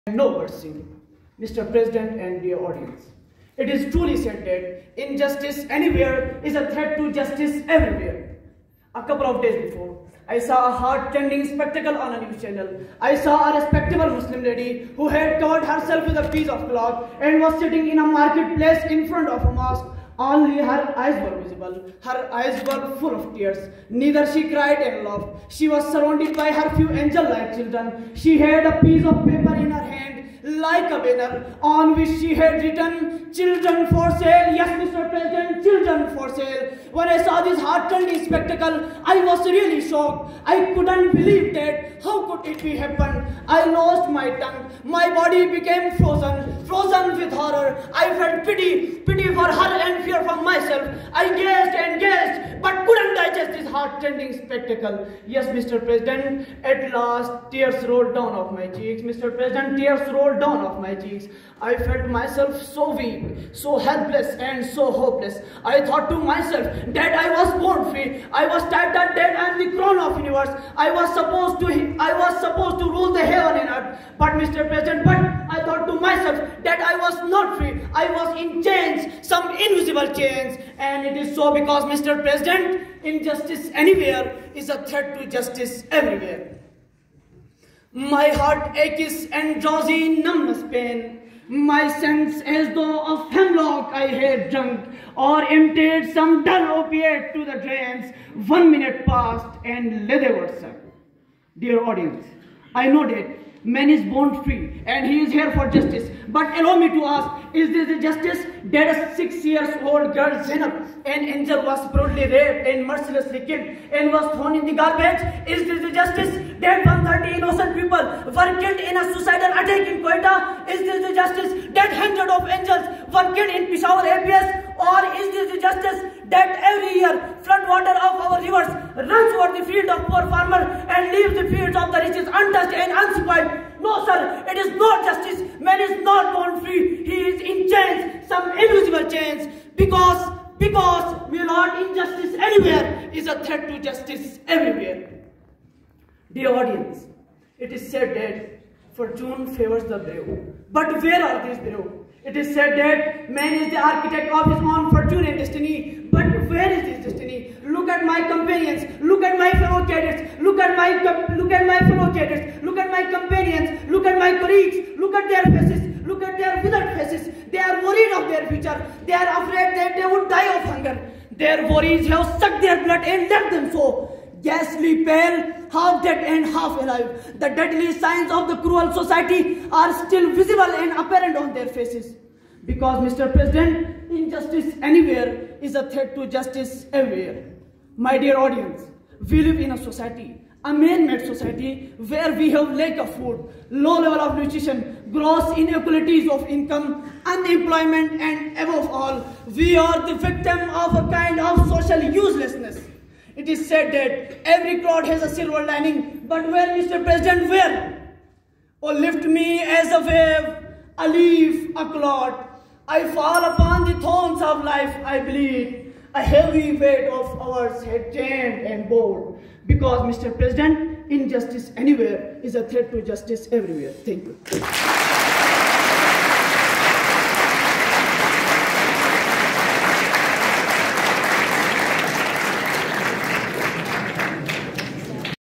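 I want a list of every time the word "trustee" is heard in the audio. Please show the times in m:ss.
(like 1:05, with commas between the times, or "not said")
not said.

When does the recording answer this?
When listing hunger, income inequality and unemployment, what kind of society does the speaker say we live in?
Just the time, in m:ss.
3:10.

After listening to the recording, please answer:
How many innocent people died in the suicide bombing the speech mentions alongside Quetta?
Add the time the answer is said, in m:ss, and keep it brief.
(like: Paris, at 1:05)
130, at 1:56.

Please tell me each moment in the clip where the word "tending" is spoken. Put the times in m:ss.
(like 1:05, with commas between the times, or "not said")
0:10, 0:53.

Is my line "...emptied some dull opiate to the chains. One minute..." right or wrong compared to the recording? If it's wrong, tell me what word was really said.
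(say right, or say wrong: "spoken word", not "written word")
wrong: "drains", not "chains".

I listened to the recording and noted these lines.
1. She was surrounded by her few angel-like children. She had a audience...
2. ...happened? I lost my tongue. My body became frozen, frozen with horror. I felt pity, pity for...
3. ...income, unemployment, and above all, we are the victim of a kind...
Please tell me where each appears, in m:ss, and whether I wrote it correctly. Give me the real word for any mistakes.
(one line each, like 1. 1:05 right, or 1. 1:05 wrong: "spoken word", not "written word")
1. 0:25 wrong: "piece", not "audience"
2. 0:42 right
3. 3:16 right.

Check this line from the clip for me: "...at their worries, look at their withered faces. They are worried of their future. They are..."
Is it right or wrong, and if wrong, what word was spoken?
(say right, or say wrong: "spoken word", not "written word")
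wrong: "faces", not "worries".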